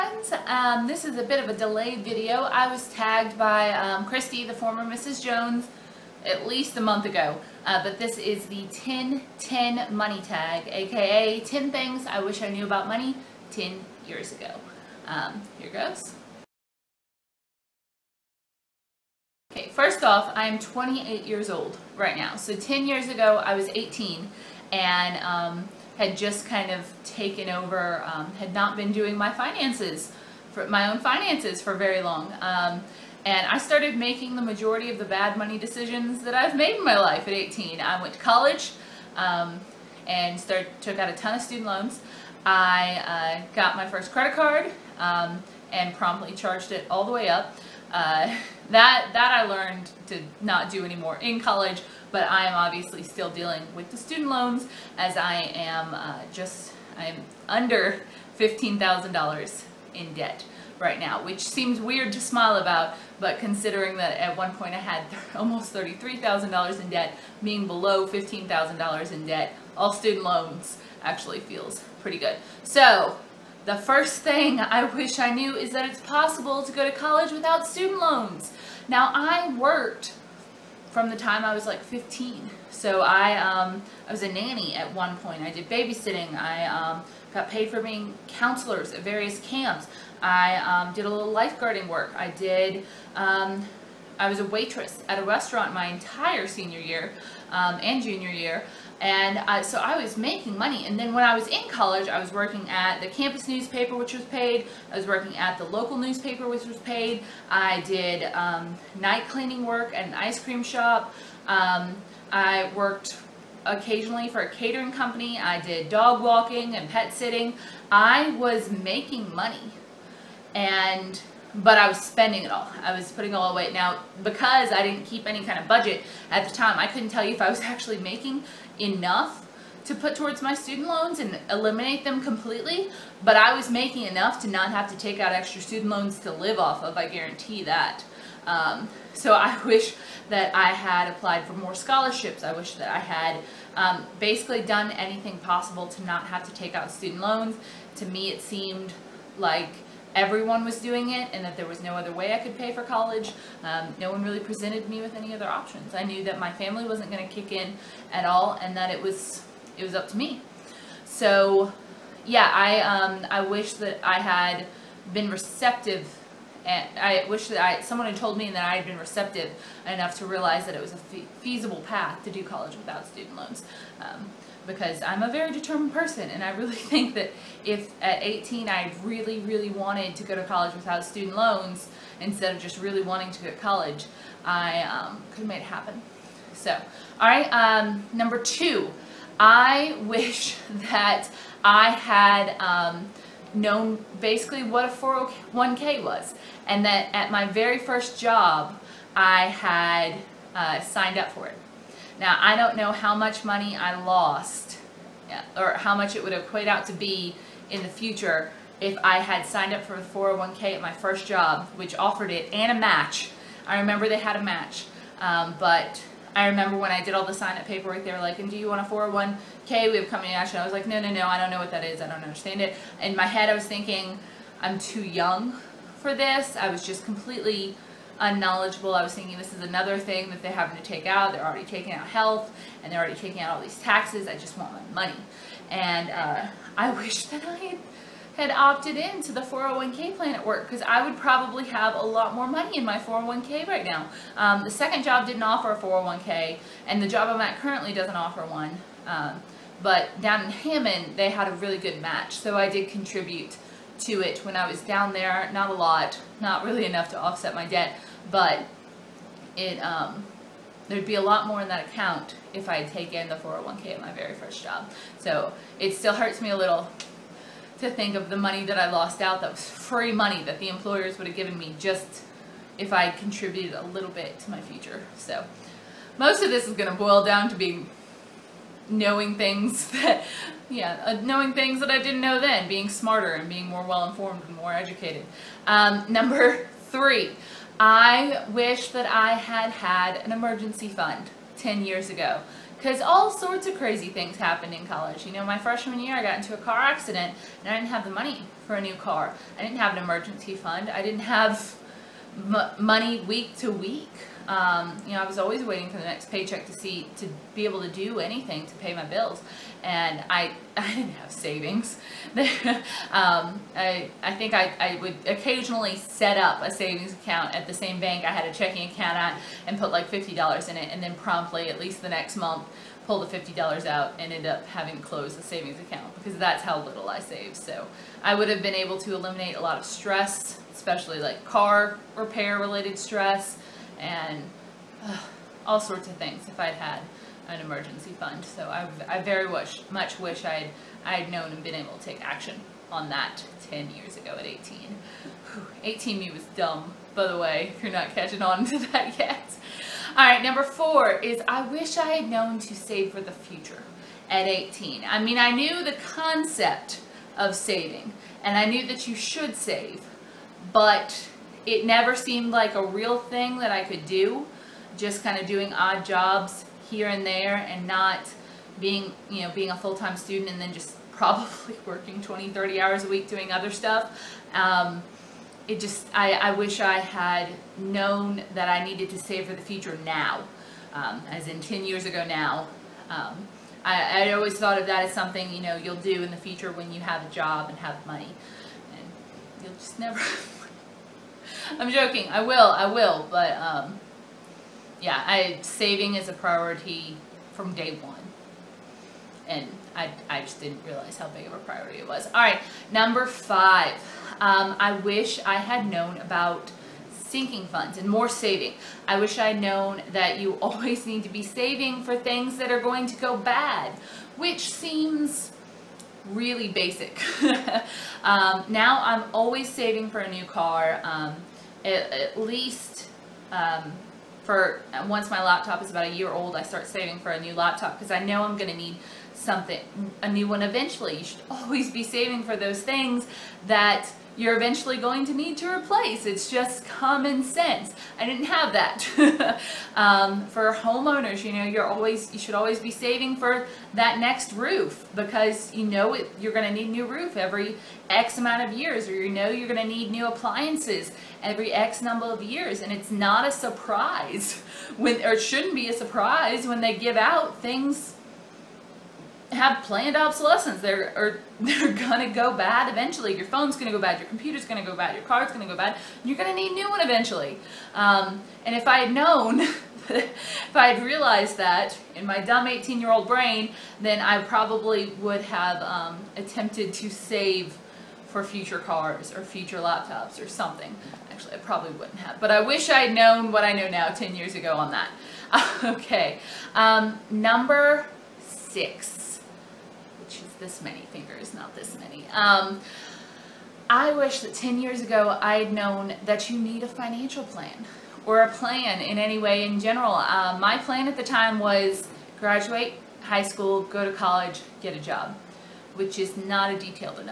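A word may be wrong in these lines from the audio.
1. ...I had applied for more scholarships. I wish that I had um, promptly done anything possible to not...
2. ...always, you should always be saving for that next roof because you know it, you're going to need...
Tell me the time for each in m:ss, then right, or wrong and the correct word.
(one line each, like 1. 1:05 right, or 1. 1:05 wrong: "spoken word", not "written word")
1. 2:20 wrong: "basically", not "promptly"
2. 7:21 right.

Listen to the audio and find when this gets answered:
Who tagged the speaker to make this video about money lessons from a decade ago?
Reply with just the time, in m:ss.
0:04.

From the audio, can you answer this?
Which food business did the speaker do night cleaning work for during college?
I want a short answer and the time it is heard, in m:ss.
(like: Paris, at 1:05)
An ice cream shop, at 1:50.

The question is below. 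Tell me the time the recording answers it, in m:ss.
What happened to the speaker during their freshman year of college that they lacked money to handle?
4:56.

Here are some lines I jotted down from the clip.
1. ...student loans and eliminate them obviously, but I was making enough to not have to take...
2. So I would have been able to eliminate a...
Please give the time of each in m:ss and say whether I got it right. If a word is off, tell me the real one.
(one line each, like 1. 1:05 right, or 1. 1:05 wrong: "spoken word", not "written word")
1. 2:10 wrong: "completely", not "obviously"
2. 5:27 right.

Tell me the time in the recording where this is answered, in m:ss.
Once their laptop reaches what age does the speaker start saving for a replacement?
7:06.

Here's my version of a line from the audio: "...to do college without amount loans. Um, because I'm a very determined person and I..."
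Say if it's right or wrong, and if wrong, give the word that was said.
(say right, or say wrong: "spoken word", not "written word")
wrong: "student", not "amount".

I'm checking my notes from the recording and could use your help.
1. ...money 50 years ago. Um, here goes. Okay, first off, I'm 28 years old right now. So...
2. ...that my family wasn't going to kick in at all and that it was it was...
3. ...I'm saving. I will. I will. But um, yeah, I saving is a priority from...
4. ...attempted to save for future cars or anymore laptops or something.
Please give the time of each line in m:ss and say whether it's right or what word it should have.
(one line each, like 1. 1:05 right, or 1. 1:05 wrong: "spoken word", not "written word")
1. 0:12 wrong: "10", not "50"
2. 2:36 right
3. 6:31 wrong: "joking", not "saving"
4. 7:56 wrong: "future", not "anymore".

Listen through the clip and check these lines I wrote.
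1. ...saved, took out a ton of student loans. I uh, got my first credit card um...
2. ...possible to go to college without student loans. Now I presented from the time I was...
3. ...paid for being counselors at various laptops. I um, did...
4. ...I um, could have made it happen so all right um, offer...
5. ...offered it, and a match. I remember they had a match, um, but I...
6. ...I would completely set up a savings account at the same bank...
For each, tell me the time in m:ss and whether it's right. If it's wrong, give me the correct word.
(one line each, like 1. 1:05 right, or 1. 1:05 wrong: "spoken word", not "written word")
1. 0:40 wrong: "started", not "saved"
2. 1:16 wrong: "worked", not "presented"
3. 1:27 wrong: "camps", not "laptops"
4. 3:04 wrong: "number", not "offer"
5. 3:31 right
6. 5:14 wrong: "occasionally", not "completely".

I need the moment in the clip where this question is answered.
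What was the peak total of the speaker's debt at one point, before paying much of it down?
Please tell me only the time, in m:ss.
1:05.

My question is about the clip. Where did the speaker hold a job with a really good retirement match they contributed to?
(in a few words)
Hammond.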